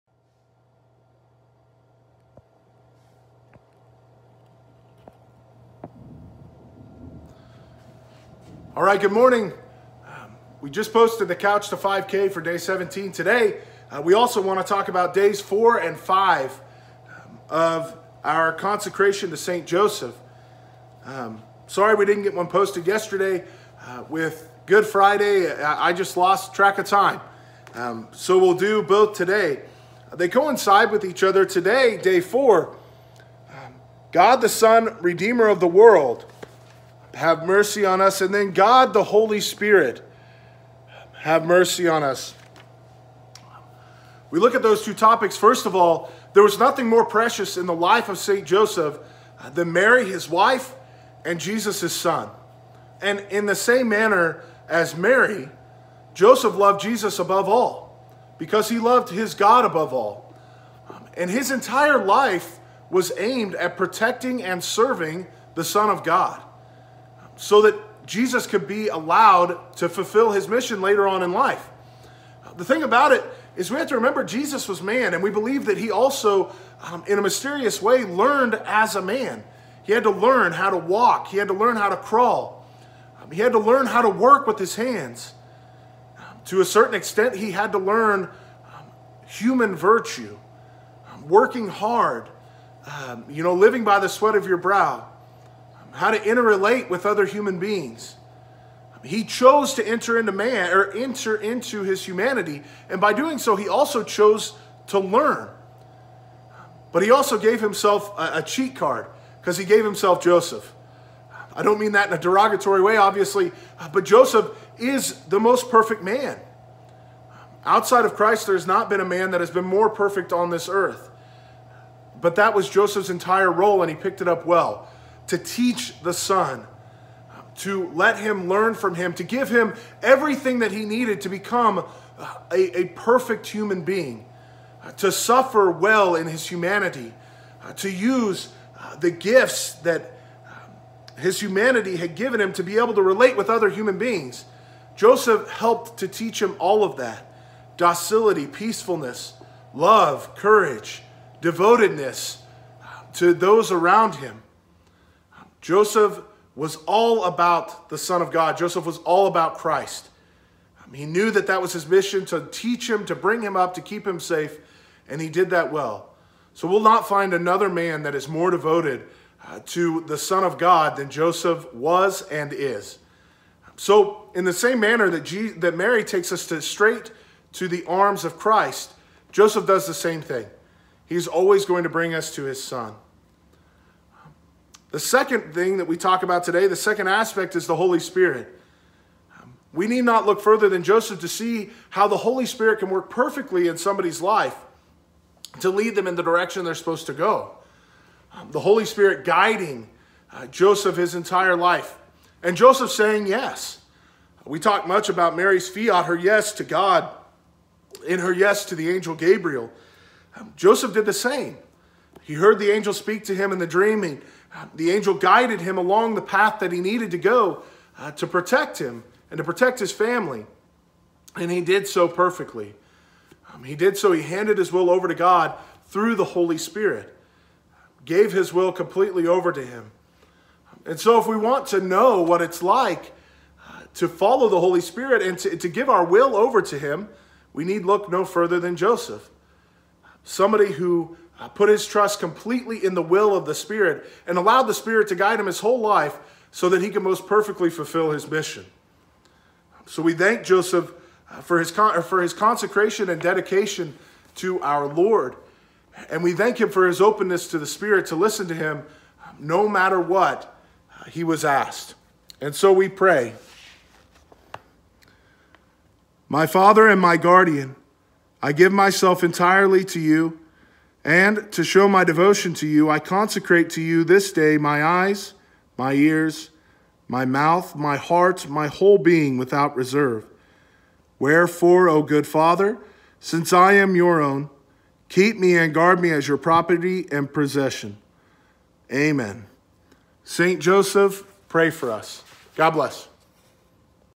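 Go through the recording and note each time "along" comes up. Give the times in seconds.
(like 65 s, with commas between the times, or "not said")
215 s.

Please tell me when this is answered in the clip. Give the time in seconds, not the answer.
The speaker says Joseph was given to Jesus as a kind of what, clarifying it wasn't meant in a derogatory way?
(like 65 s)
108 s.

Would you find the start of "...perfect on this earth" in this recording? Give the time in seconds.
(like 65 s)
119 s.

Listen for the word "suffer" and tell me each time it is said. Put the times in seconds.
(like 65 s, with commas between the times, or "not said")
135 s.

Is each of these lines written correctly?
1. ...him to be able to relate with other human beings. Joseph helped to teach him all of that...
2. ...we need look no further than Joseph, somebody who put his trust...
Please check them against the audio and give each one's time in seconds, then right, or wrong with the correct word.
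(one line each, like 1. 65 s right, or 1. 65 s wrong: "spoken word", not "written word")
1. 142 s right
2. 237 s right.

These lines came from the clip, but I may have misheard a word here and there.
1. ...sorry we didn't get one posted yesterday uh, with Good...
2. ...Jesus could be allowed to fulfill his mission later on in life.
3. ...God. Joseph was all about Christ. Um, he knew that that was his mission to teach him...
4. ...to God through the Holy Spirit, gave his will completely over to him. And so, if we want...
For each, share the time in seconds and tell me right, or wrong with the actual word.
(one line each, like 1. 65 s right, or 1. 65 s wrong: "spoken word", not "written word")
1. 21 s right
2. 68 s right
3. 158 s right
4. 225 s right.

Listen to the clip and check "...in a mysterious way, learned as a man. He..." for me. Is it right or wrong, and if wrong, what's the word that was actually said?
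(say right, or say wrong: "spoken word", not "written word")
right.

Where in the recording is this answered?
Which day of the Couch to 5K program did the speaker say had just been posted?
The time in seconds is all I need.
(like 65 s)
12 s.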